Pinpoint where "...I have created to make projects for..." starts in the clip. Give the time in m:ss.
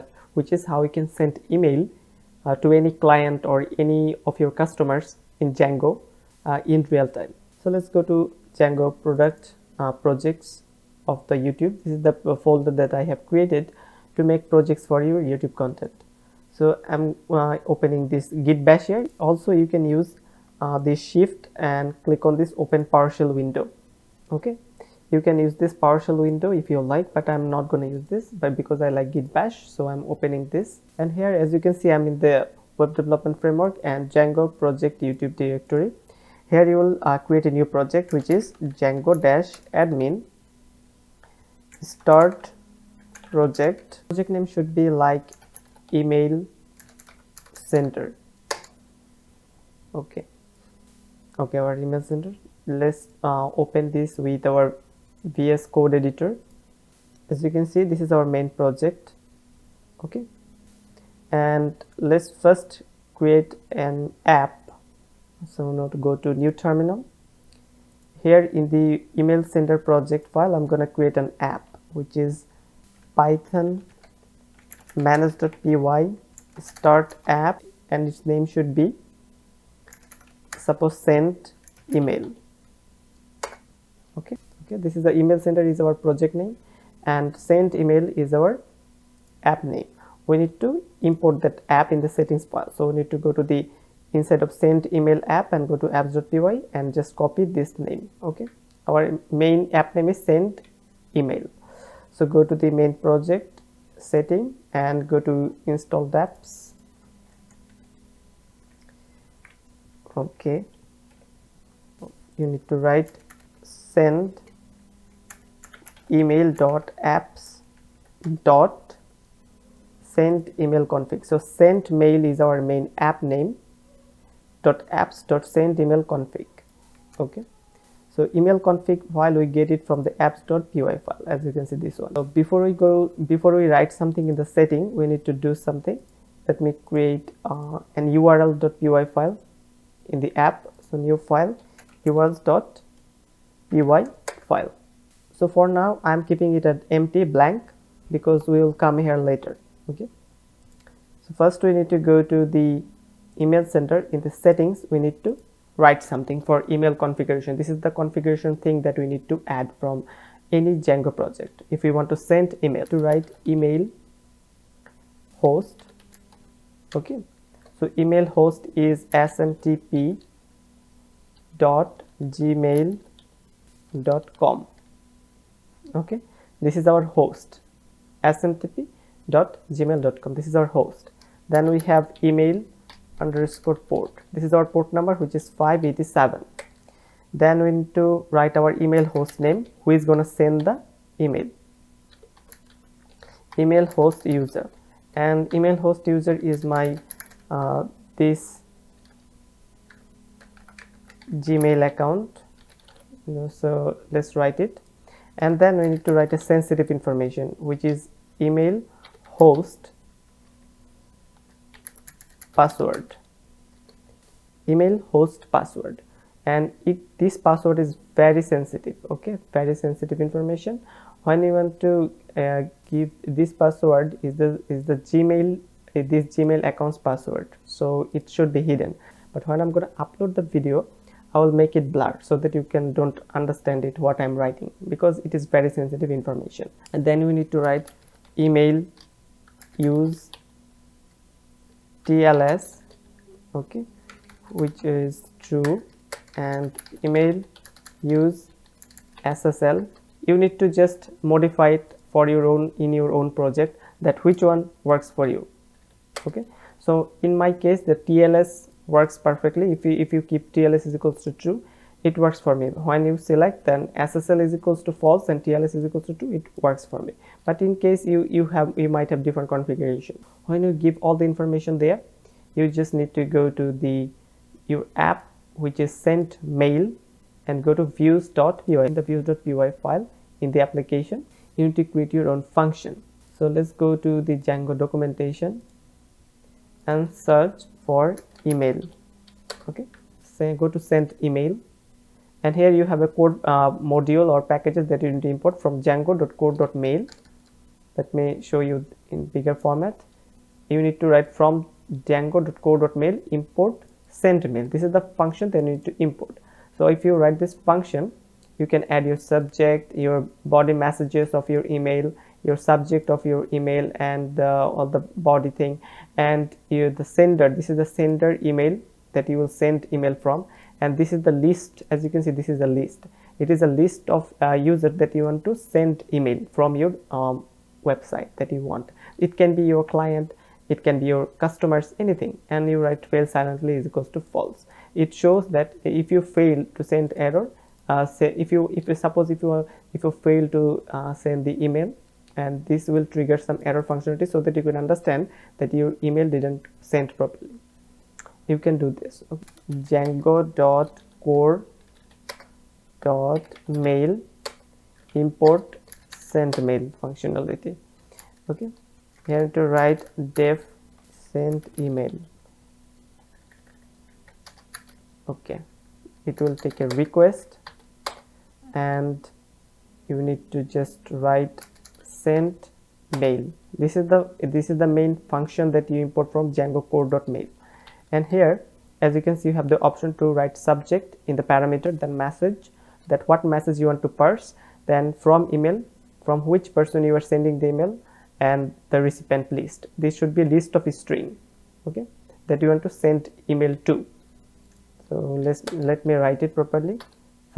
0:12.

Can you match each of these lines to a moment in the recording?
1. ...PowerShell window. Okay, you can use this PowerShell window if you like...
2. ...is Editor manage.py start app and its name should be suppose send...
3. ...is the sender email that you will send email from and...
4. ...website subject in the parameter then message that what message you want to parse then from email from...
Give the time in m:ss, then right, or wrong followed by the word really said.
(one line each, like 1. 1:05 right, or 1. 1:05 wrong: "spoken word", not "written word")
1. 0:22 right
2. 1:12 wrong: "Python", not "Editor"
3. 5:17 right
4. 6:20 wrong: "write", not "website".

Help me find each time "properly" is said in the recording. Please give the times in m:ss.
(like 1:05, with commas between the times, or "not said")
5:47, 6:36.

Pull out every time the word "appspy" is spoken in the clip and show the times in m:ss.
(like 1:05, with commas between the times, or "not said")
1:35, 2:10.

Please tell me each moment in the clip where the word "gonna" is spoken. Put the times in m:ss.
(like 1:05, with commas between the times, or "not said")
0:27.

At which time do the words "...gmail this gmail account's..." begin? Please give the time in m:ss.
3:44.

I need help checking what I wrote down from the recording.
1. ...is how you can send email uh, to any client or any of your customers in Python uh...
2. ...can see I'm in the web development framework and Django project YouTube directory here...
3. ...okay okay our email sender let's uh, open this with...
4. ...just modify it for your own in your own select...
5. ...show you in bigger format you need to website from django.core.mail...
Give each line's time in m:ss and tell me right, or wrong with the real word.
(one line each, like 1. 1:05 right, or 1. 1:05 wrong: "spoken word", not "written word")
1. 0:00 wrong: "Django", not "Python"
2. 0:31 right
3. 0:49 right
4. 4:10 wrong: "project", not "select"
5. 4:58 wrong: "write", not "website".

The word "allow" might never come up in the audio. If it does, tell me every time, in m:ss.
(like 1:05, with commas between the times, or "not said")
not said.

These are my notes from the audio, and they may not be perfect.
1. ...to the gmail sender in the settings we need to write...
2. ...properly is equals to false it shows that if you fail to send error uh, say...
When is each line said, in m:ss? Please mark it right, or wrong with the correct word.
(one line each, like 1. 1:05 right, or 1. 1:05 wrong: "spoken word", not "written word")
1. 2:32 wrong: "email", not "gmail"
2. 5:33 wrong: "silently", not "properly".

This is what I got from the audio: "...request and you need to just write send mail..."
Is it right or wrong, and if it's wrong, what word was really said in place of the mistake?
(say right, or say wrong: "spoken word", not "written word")
right.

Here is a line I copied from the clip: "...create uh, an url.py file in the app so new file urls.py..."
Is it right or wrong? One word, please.
right.